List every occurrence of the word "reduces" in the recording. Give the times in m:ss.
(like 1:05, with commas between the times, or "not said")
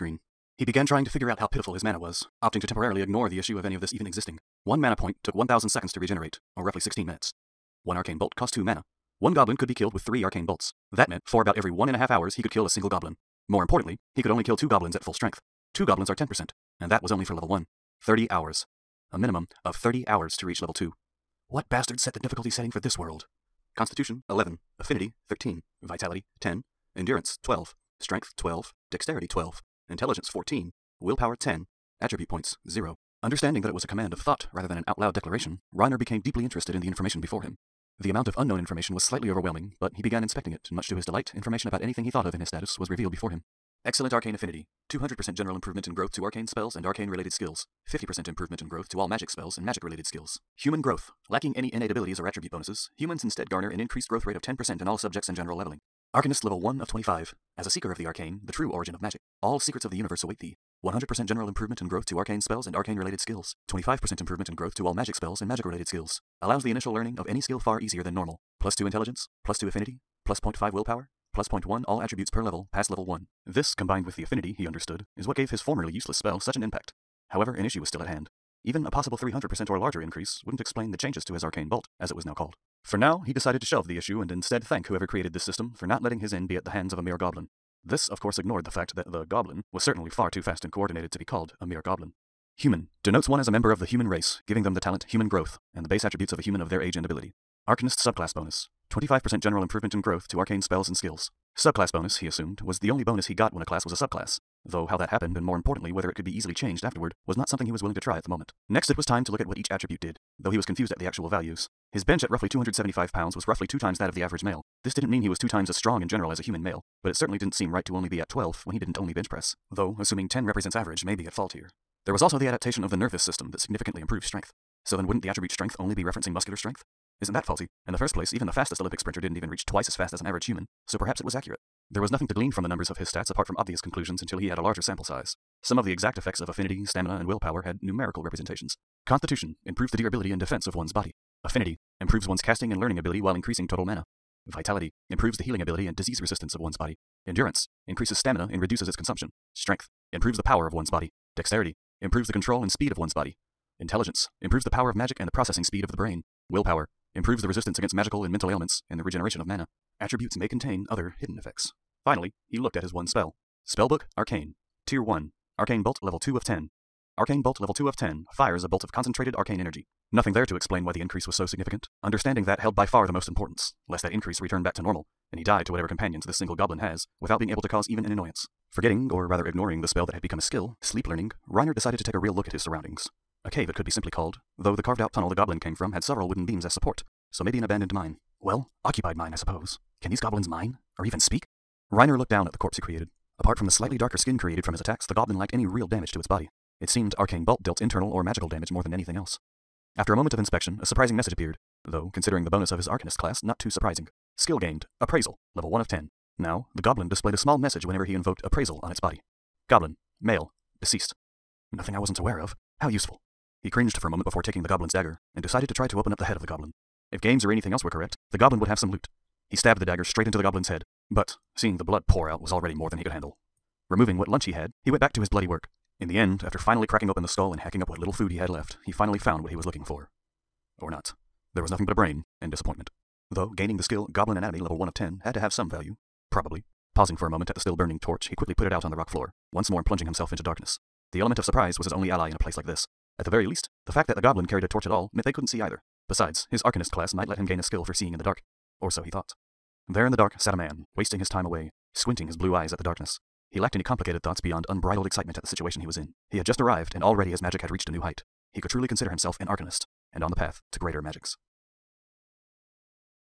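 2:28.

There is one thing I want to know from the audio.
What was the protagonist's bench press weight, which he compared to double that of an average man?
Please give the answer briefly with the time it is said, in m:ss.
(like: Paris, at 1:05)
275 pounds, at 1:52.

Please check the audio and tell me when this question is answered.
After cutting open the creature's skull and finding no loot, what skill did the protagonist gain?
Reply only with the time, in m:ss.
3:54.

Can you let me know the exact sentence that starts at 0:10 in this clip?
That meant, for about every one and a half hours, he could kill a single goblin.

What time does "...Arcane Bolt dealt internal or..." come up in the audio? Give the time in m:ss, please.
3:17.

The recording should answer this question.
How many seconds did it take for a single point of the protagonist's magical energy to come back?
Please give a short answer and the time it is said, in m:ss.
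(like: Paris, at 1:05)
1000, at 0:05.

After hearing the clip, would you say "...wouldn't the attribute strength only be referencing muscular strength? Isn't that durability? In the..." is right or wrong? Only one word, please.
wrong.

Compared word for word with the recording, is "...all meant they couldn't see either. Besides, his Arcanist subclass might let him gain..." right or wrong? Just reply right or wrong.
wrong.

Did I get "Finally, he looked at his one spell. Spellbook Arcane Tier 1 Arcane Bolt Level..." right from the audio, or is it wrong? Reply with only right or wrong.
right.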